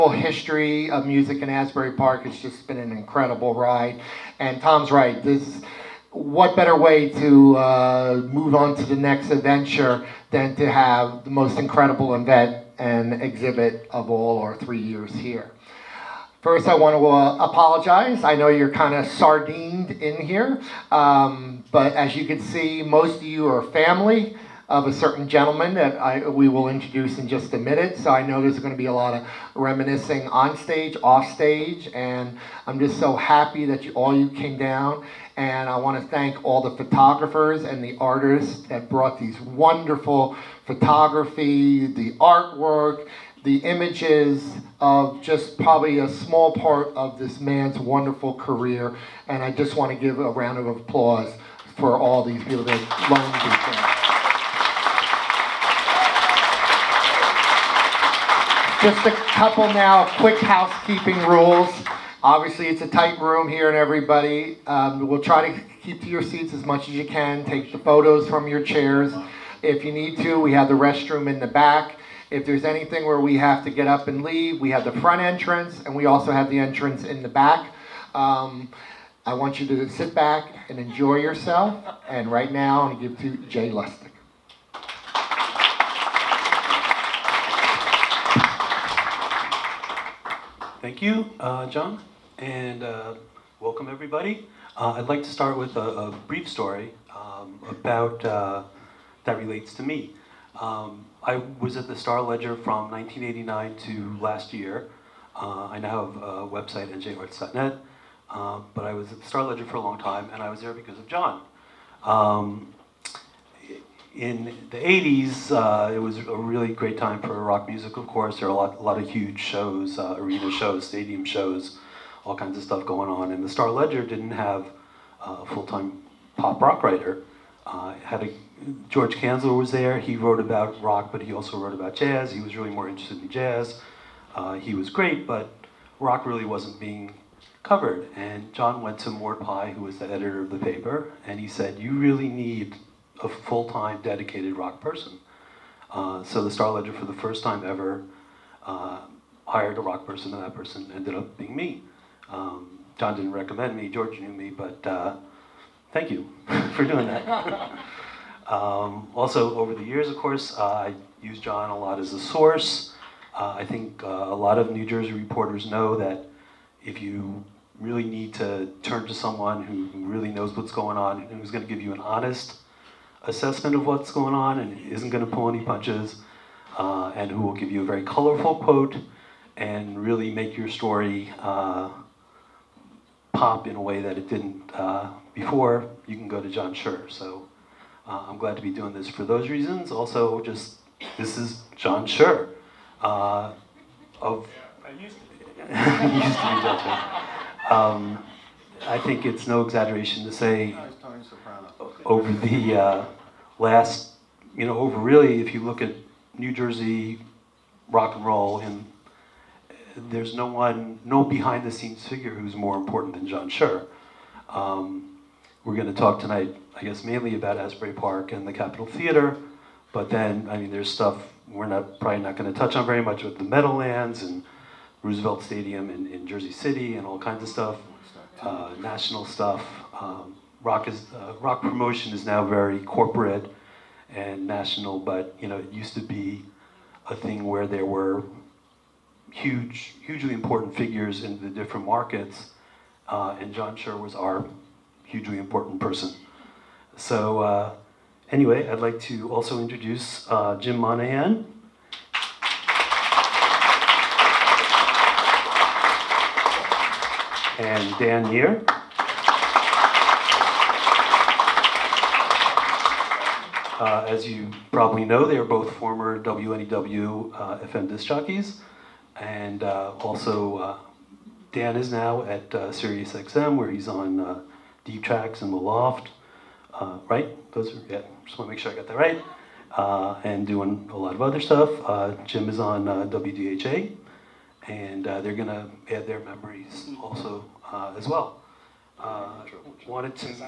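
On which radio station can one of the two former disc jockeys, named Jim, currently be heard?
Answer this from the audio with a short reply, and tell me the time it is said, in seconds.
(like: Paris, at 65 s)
WDHA, at 282 s.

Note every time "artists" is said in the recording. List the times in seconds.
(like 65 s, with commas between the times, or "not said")
37 s.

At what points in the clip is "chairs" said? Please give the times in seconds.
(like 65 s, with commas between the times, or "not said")
68 s.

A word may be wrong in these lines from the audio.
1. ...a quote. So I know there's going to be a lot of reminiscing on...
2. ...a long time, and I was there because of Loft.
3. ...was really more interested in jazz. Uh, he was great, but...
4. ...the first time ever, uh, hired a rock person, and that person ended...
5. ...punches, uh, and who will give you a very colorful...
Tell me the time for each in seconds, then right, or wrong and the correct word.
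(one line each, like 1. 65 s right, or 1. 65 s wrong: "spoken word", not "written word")
1. 27 s wrong: "minute", not "quote"
2. 109 s wrong: "John", not "Loft"
3. 132 s right
4. 147 s right
5. 175 s right.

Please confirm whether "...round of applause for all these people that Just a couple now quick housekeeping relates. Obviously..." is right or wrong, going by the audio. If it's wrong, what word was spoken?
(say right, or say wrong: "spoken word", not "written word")
wrong: "rules", not "relates".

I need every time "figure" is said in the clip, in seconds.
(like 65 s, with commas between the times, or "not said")
212 s, 240 s.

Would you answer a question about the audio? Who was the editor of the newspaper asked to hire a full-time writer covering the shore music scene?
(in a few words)
Mort Pye.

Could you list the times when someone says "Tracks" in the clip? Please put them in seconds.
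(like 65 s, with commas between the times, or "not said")
275 s.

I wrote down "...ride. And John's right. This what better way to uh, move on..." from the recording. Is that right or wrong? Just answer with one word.
wrong.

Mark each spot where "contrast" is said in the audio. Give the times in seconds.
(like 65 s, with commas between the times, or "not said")
not said.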